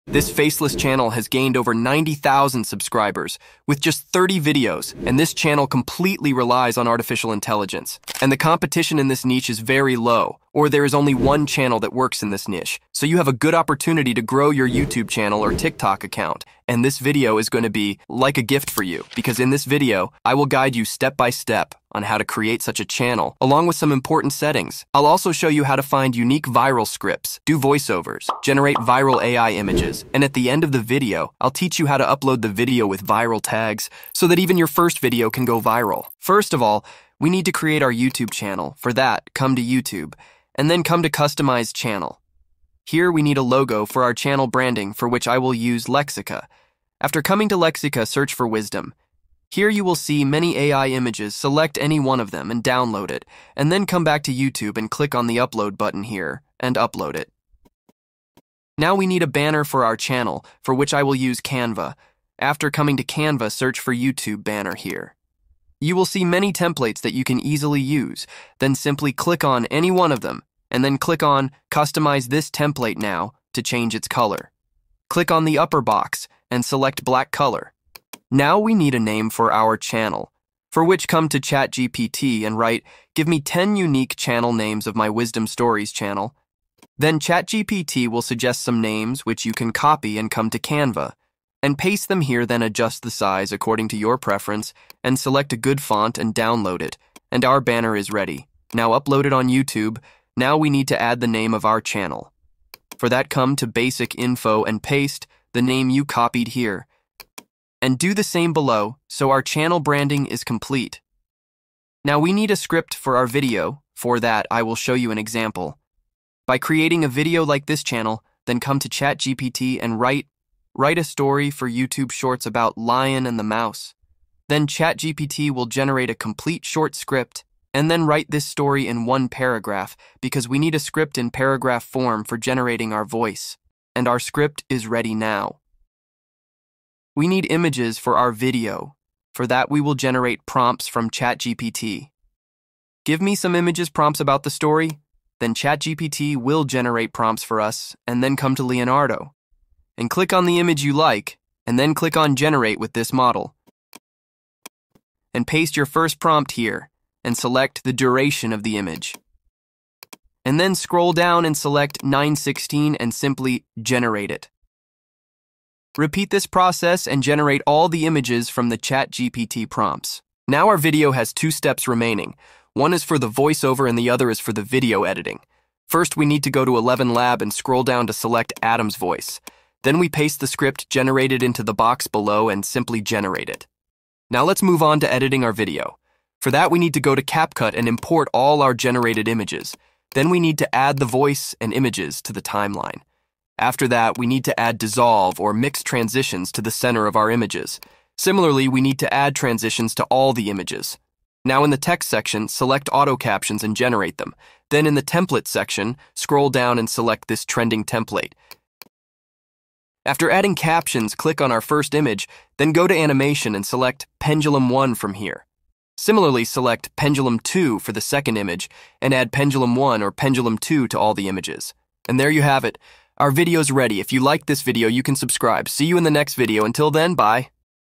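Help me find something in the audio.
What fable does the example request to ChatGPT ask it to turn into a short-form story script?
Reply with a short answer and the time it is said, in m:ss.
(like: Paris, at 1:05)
Lion and the Mouse, at 2:02.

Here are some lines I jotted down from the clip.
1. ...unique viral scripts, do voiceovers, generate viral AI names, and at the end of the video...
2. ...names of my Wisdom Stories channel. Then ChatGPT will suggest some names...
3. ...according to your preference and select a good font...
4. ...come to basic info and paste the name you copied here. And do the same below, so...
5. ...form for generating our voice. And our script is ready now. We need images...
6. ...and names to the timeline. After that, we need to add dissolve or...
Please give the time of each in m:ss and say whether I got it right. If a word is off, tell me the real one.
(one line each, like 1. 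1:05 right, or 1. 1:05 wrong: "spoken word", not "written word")
1. 0:26 wrong: "images", not "names"
2. 1:24 right
3. 1:33 right
4. 1:43 right
5. 2:11 right
6. 3:11 wrong: "images", not "names".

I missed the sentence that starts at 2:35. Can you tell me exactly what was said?
And paste your first prompt here, and select the duration of the image.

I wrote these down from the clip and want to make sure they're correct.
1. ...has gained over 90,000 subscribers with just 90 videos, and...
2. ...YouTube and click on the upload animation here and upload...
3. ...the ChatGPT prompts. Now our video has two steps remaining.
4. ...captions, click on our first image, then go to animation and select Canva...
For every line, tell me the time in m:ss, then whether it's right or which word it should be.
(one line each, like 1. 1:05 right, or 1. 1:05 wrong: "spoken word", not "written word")
1. 0:01 wrong: "30", not "90"
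2. 0:54 wrong: "button", not "animation"
3. 2:48 right
4. 3:30 wrong: "Pendulum", not "Canva".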